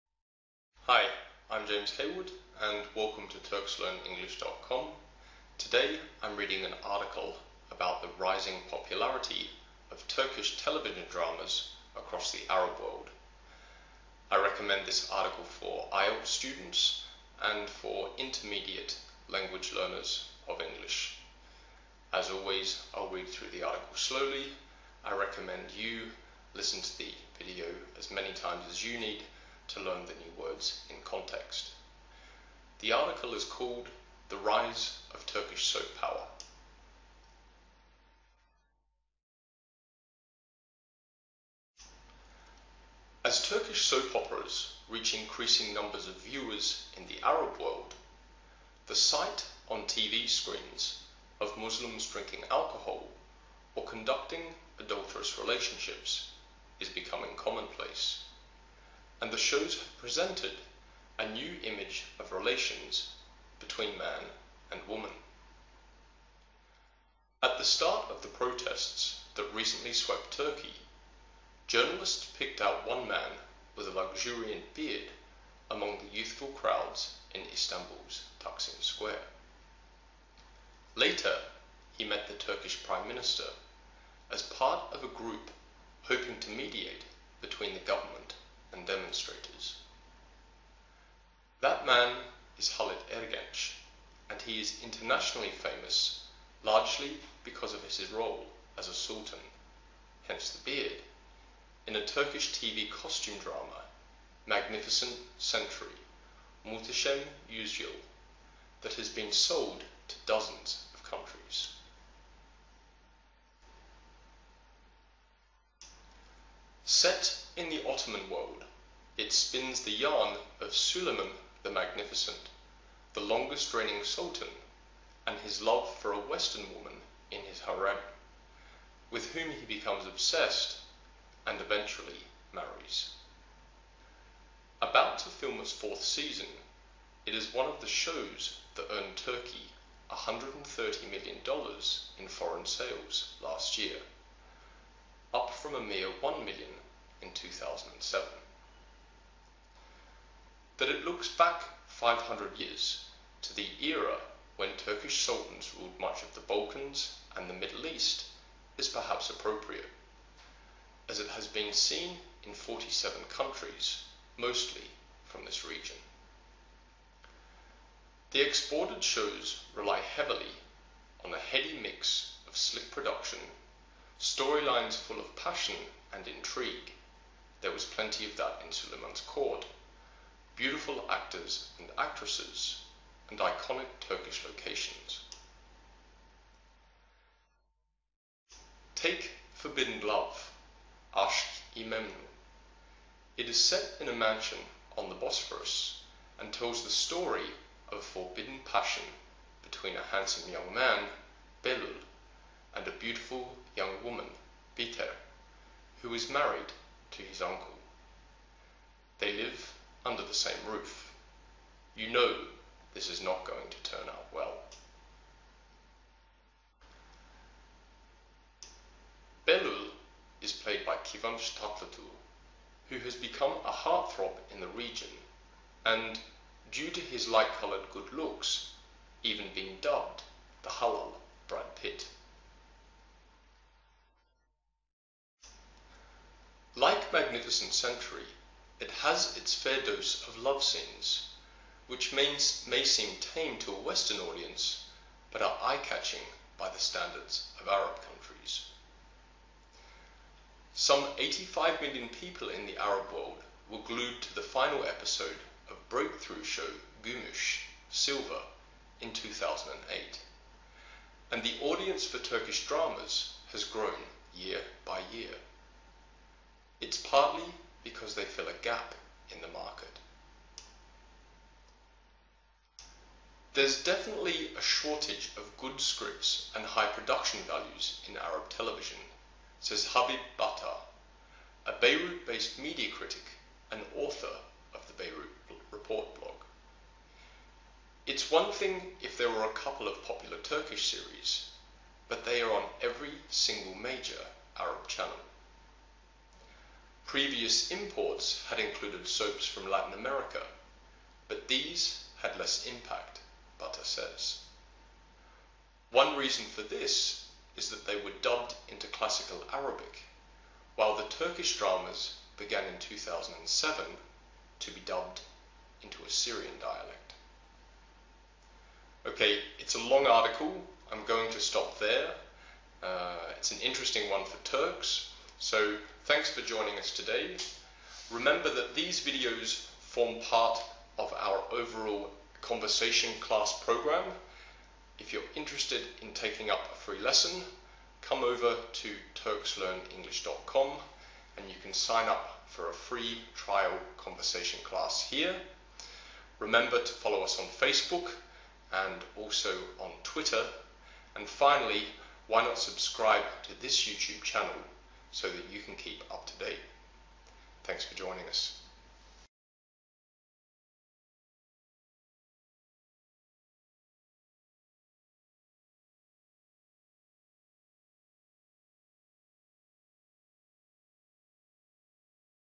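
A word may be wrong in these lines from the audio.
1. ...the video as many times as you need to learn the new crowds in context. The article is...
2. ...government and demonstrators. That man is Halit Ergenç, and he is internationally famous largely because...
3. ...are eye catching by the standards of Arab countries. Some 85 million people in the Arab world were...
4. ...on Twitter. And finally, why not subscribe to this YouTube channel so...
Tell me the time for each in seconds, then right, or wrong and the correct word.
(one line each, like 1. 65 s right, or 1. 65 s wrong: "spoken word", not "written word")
1. 26 s wrong: "words", not "crowds"
2. 87 s right
3. 245 s right
4. 349 s right.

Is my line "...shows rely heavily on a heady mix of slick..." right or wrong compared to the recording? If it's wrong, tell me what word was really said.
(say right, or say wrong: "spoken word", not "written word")
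right.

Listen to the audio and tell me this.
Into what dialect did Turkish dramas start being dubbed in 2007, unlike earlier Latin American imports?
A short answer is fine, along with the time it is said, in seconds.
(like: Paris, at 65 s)
a Syrian dialect, at 316 s.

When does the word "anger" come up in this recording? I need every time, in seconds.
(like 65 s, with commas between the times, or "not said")
not said.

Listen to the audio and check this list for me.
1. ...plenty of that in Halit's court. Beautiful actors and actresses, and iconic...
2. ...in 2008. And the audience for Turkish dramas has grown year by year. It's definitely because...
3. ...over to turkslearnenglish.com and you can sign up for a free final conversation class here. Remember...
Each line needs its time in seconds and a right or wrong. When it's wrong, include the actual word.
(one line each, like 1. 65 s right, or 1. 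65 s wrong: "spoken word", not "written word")
1. 177 s wrong: "Suleiman", not "Halit"
2. 259 s wrong: "partly", not "definitely"
3. 338 s wrong: "trial", not "final".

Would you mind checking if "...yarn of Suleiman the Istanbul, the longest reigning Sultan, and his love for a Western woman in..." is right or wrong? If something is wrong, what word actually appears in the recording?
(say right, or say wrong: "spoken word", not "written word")
wrong: "Magnificent", not "Istanbul".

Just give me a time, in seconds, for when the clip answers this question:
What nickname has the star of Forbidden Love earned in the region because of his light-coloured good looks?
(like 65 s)
230 s.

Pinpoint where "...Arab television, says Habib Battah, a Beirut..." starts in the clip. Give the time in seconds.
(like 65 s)
278 s.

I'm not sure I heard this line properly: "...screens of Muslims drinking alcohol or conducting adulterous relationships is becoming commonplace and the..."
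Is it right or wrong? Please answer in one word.
right.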